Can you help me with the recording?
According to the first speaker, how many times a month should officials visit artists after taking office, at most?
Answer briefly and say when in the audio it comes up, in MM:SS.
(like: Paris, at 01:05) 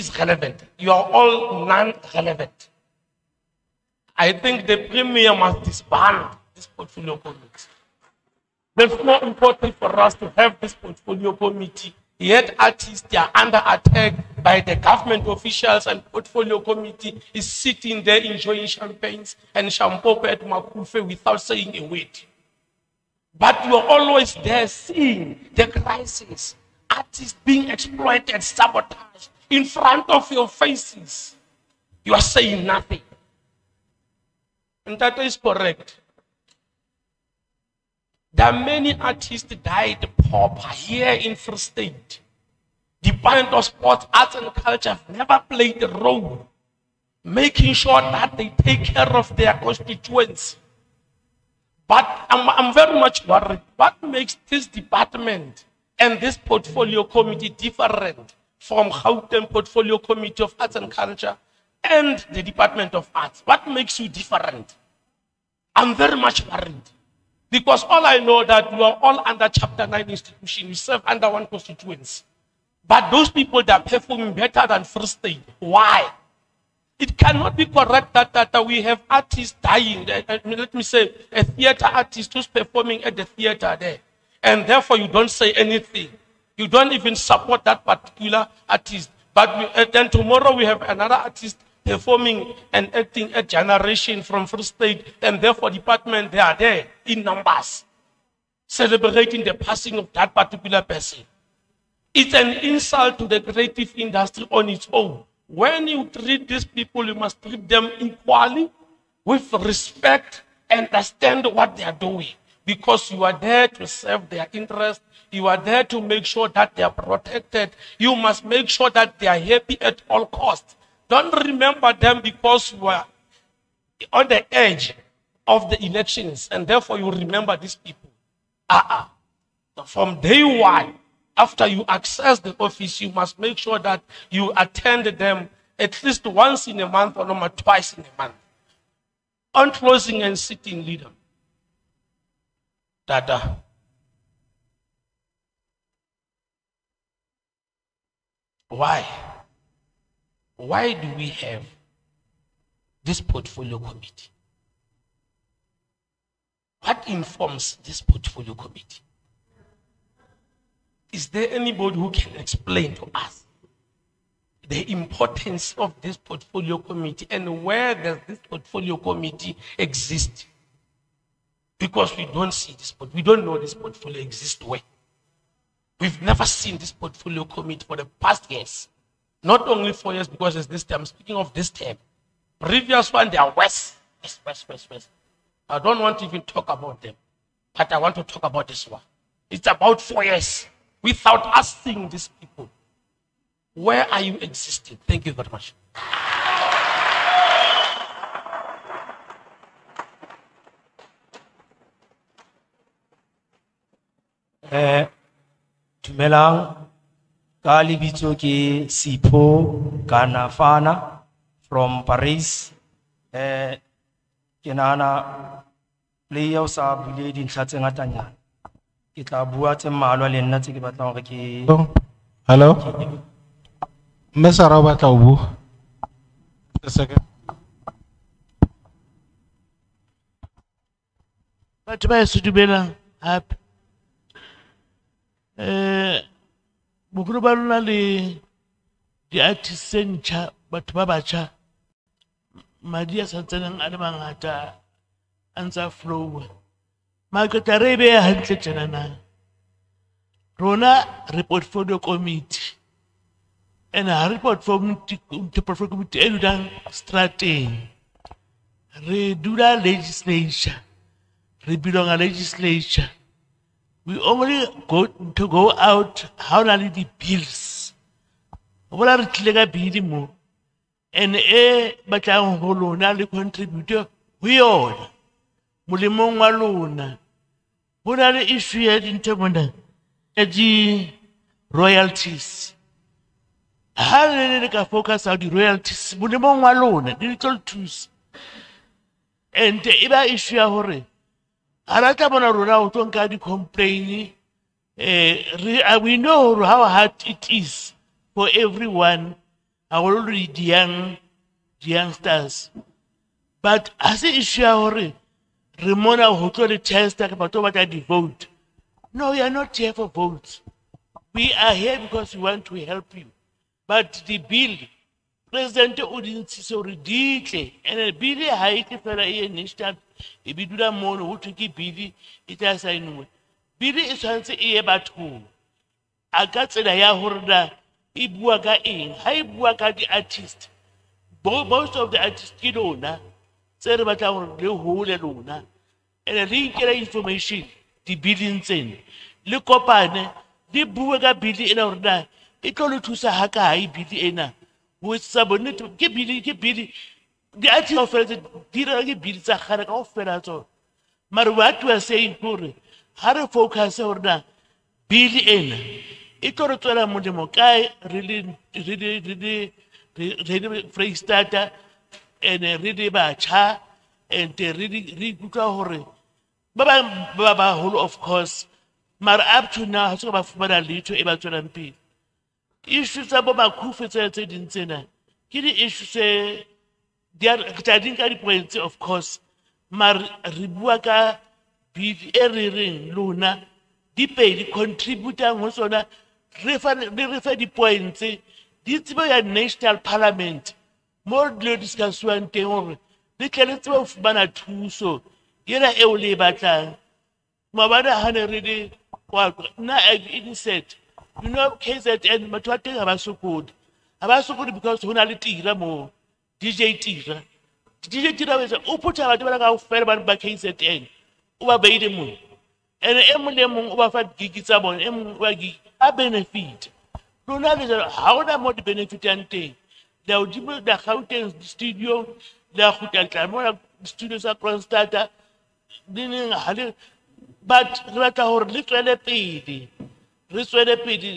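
twice, at 02:17.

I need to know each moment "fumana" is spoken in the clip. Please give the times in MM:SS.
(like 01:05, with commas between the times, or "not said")
06:10, 06:34.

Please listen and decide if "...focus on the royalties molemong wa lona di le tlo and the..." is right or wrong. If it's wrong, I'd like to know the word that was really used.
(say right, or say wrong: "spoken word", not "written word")
right.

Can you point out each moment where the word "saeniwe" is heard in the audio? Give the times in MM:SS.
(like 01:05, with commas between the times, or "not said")
05:22.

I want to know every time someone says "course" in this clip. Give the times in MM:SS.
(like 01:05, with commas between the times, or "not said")
06:08, 06:18.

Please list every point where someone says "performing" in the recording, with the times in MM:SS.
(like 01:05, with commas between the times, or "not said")
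01:13, 01:22, 01:31.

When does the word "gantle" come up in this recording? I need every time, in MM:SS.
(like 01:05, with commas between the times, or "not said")
04:08.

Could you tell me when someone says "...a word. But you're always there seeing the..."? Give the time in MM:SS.
00:21.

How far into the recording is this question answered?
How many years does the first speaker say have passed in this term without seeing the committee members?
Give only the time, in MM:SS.
03:09.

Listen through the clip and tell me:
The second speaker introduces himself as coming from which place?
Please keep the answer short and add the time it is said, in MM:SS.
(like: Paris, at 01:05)
Paris, at 03:32.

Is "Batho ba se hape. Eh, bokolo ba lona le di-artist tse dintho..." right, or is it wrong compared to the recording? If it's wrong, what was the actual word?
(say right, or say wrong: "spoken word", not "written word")
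wrong: "batho", not "dintho".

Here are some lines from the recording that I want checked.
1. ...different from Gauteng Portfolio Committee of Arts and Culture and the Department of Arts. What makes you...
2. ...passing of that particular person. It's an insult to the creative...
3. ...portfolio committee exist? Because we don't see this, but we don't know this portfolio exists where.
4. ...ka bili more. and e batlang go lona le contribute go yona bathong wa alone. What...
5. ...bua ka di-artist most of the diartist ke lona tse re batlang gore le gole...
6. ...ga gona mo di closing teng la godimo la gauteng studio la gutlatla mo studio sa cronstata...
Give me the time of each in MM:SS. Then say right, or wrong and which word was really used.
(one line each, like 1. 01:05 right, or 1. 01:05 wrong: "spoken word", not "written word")
1. 00:57 right
2. 01:39 right
3. 02:48 right
4. 04:29 wrong: "molemong", not "bathong"
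5. 05:29 wrong: "artist", not "diartist"
6. 06:58 wrong: "benefitang", not "closing".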